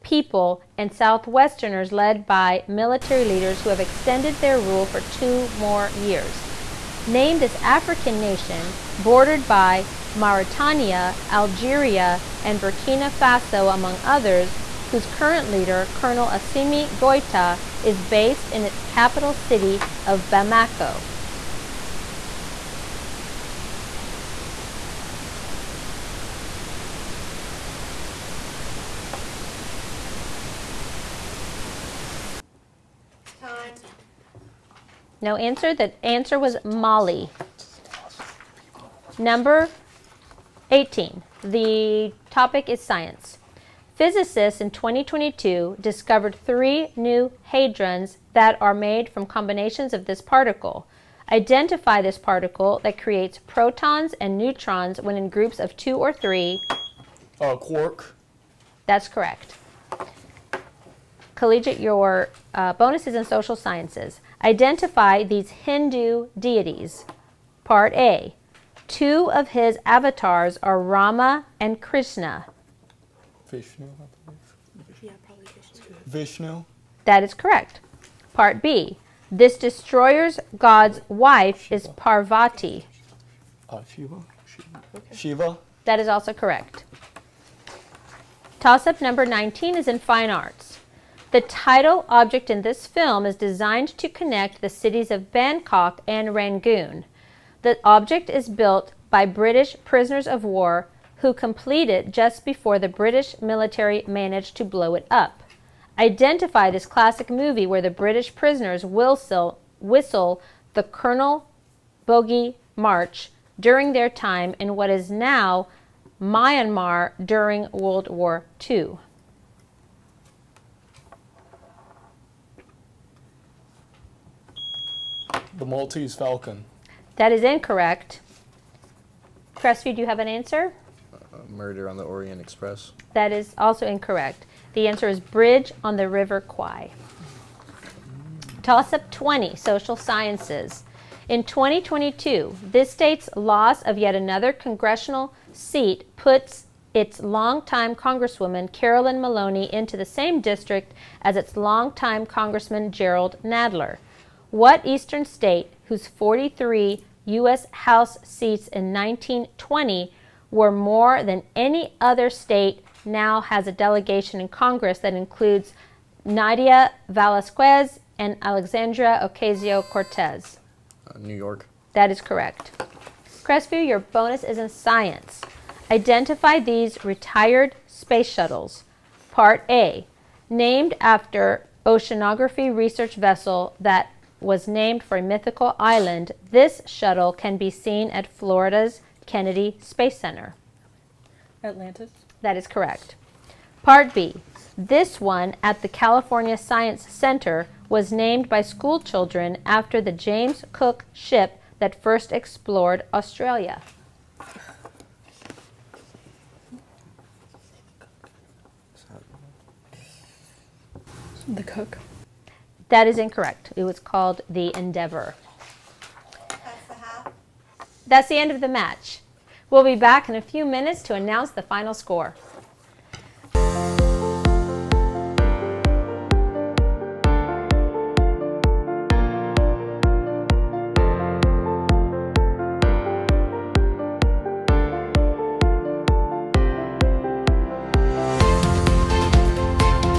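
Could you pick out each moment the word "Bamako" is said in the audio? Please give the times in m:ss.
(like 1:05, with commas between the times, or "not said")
0:20.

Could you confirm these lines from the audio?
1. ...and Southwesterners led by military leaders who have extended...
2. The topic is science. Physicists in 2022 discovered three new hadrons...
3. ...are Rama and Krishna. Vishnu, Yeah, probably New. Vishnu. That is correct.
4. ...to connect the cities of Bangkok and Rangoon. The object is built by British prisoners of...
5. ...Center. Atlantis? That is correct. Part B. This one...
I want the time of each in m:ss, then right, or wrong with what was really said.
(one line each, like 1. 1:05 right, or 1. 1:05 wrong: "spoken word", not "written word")
1. 0:00 right
2. 0:41 right
3. 1:10 wrong: "Vishnu", not "New"
4. 1:33 right
5. 3:10 right.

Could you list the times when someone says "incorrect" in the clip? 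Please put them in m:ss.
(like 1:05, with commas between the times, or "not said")
2:07, 2:13, 3:33.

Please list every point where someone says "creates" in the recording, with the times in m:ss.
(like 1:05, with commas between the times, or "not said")
0:53.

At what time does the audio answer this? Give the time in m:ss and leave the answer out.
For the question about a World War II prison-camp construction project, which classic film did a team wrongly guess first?
2:05.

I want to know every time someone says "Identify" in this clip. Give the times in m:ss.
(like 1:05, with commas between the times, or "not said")
0:51, 1:04, 1:45, 2:55.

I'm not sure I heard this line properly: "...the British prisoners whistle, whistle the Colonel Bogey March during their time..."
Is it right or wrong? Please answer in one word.
right.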